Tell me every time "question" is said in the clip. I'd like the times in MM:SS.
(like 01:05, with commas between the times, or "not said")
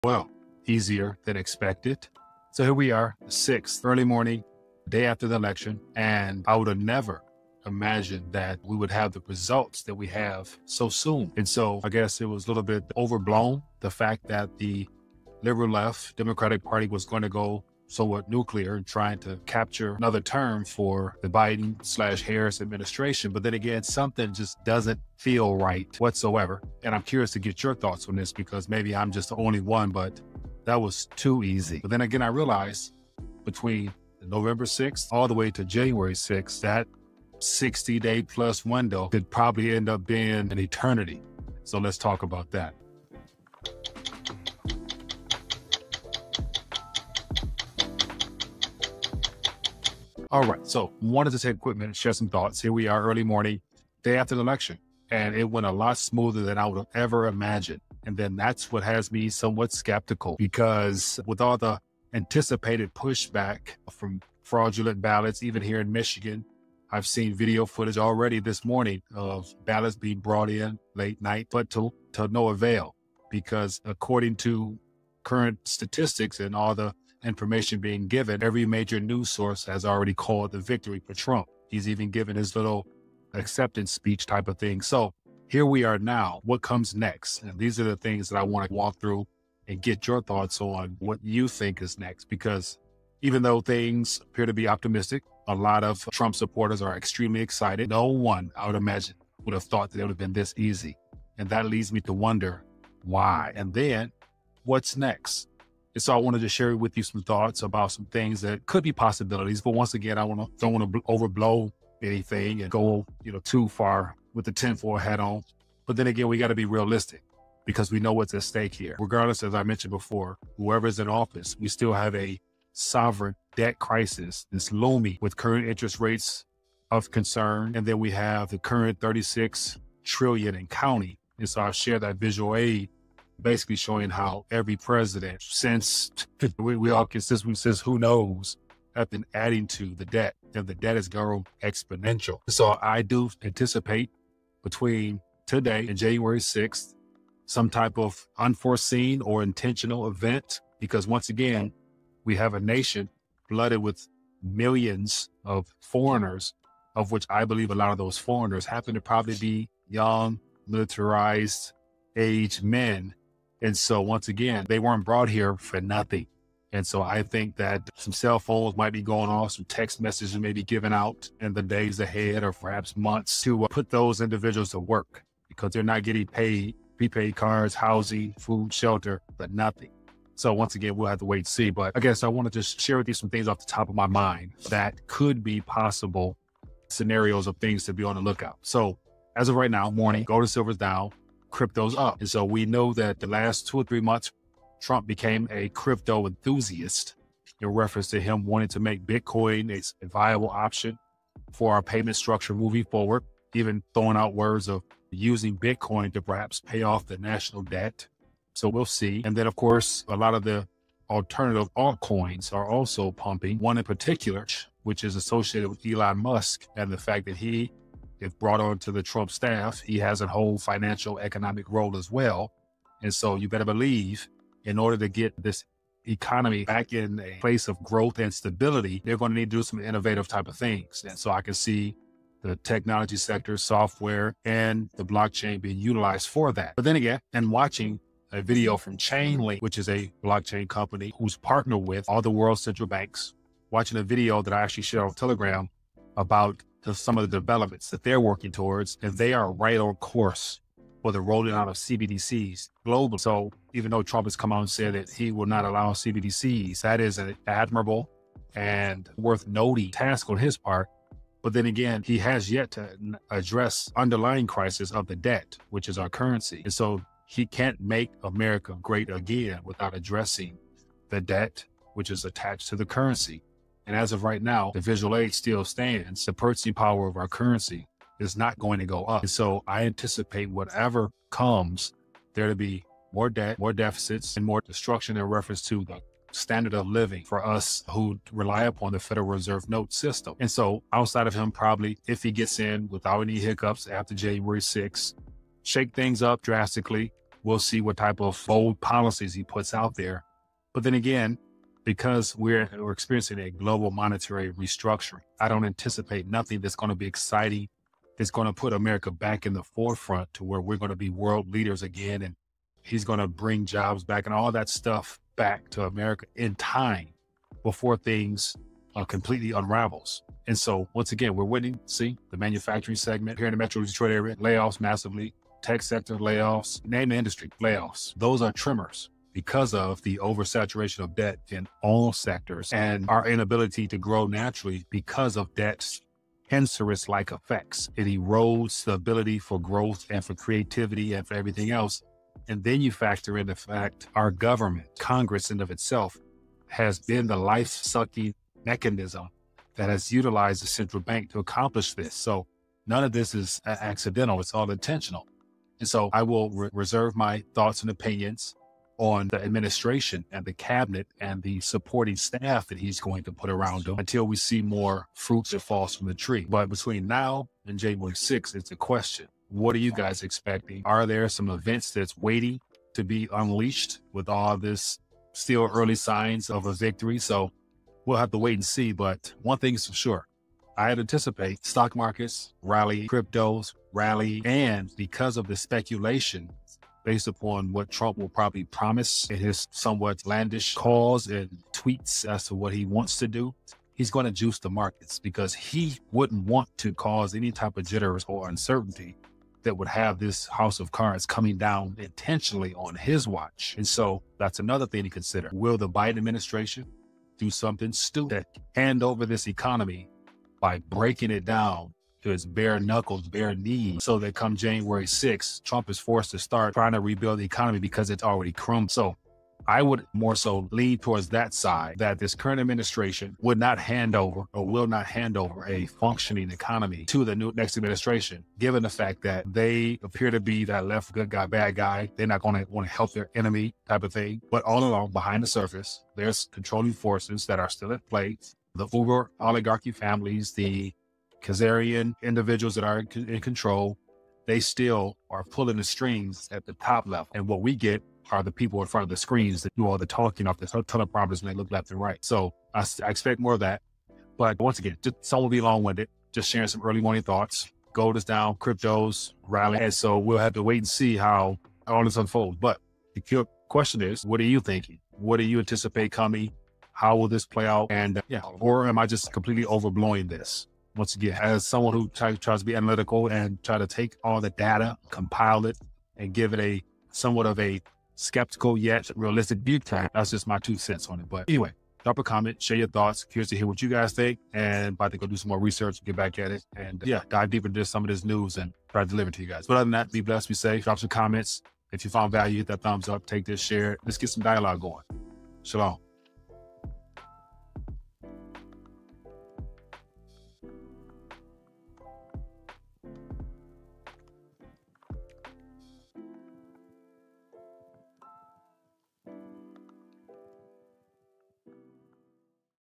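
06:08, 07:43.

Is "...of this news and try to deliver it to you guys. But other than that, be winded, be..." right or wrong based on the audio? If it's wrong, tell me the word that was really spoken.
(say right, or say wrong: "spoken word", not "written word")
wrong: "blessed", not "winded".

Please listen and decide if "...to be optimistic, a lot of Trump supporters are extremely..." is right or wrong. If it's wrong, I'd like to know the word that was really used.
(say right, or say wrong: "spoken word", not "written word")
right.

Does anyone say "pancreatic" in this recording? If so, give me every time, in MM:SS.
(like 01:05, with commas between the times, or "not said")
not said.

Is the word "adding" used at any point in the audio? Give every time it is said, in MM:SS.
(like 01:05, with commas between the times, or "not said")
02:19.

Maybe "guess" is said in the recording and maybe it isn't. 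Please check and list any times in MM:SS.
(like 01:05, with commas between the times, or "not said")
00:11, 03:01.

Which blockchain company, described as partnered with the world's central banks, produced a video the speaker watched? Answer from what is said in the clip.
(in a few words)
Chainlink.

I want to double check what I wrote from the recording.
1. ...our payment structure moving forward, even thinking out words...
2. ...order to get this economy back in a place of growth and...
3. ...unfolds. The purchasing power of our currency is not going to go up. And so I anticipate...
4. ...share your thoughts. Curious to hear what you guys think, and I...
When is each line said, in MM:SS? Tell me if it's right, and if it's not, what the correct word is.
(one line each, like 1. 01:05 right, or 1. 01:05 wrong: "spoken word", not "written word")
1. 03:21 wrong: "throwing", not "thinking"
2. 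03:44 right
3. 04:35 wrong: "stands", not "unfolds"
4. 08:02 right.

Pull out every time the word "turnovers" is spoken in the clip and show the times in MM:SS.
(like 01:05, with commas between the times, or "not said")
not said.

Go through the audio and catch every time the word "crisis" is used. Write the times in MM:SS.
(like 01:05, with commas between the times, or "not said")
02:03, 04:24.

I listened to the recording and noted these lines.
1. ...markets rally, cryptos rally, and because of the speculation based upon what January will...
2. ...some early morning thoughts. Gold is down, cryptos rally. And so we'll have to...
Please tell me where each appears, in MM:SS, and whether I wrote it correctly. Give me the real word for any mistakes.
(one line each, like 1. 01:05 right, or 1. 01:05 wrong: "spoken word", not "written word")
1. 06:21 wrong: "Trump", not "January"
2. 07:36 right.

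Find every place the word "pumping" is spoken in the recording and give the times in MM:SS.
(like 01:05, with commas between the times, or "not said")
03:33.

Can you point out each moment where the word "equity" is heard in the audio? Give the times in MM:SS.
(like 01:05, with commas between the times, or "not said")
not said.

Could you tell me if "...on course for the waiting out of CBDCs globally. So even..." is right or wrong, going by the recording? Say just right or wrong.
wrong.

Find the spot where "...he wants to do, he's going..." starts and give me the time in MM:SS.
06:32.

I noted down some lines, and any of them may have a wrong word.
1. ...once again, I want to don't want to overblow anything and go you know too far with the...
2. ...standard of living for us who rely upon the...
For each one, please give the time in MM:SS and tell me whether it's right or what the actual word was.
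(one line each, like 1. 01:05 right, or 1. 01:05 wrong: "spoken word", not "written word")
1. 01:49 right
2. 04:46 right.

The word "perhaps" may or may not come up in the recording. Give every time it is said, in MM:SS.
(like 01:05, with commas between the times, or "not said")
02:52, 03:26.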